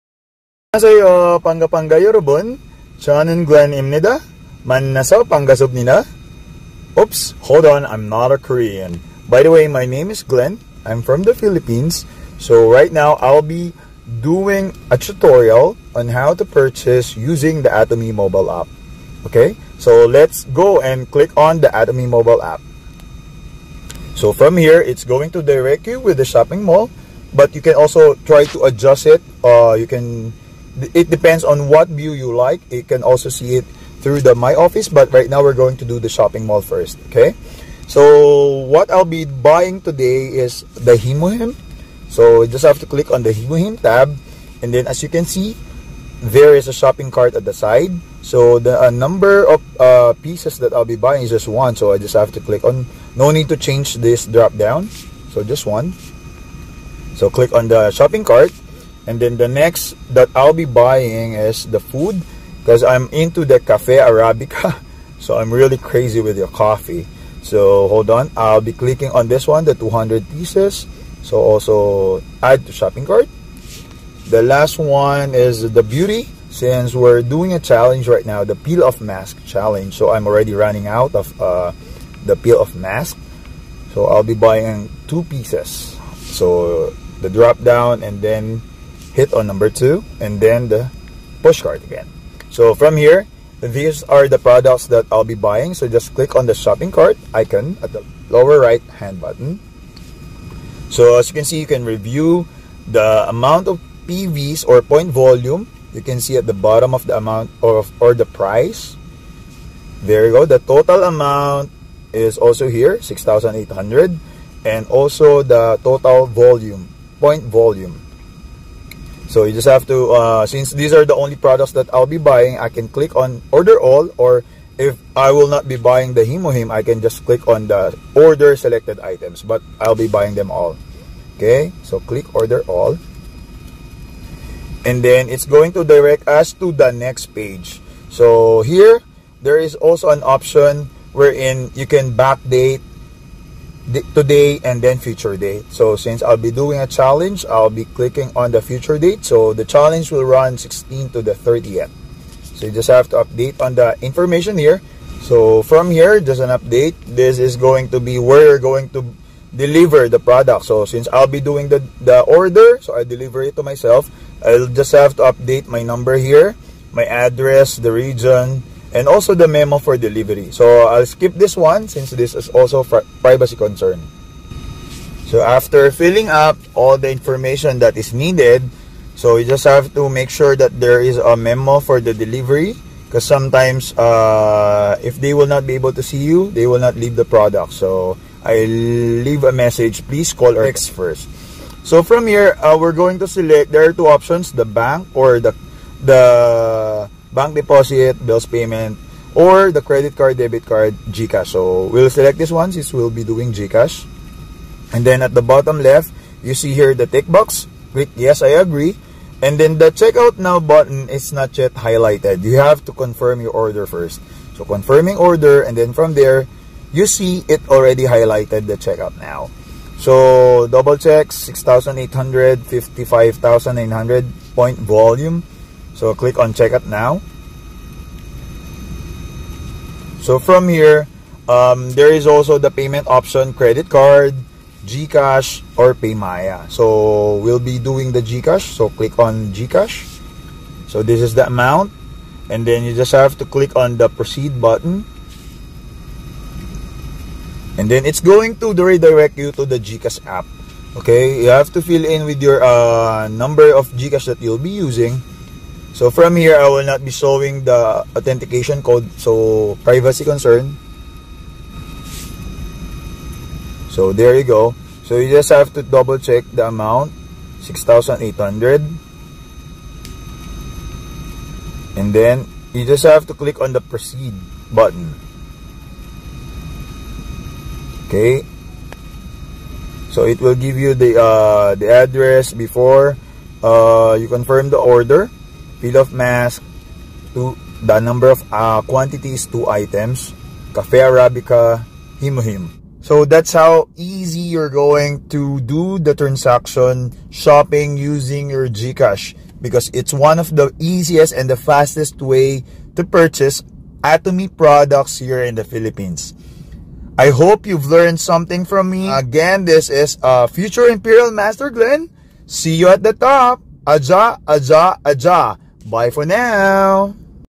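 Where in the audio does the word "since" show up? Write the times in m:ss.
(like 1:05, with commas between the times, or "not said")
1:16, 2:00, 2:25, 2:40, 2:51, 3:22.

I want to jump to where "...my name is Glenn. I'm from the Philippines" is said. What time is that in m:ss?
0:09.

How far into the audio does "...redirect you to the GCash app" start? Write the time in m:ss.
4:08.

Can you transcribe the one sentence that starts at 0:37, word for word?
So what I'll be buying today is the HemoHIM.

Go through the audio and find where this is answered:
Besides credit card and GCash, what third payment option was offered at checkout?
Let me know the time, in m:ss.
3:55.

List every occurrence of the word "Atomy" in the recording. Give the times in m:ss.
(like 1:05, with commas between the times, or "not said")
0:17, 0:21, 5:04.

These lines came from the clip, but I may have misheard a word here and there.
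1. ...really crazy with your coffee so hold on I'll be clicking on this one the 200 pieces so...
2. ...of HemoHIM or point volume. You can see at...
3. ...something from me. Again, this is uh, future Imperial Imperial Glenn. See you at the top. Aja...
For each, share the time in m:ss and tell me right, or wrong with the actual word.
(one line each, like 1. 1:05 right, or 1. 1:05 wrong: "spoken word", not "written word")
1. 1:05 right
2. 1:43 wrong: "PVs", not "HemoHIM"
3. 5:08 wrong: "Master", not "Imperial".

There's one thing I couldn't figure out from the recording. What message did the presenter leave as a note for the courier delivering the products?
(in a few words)
Please call or text first.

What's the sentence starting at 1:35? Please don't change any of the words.
So just click on the shopping cart icon at the lower right hand button.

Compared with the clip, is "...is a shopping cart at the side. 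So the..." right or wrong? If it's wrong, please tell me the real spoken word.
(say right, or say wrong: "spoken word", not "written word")
right.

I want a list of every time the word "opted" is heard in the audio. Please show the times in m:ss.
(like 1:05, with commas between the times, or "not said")
not said.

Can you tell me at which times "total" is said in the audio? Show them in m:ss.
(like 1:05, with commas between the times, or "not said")
1:50, 1:55.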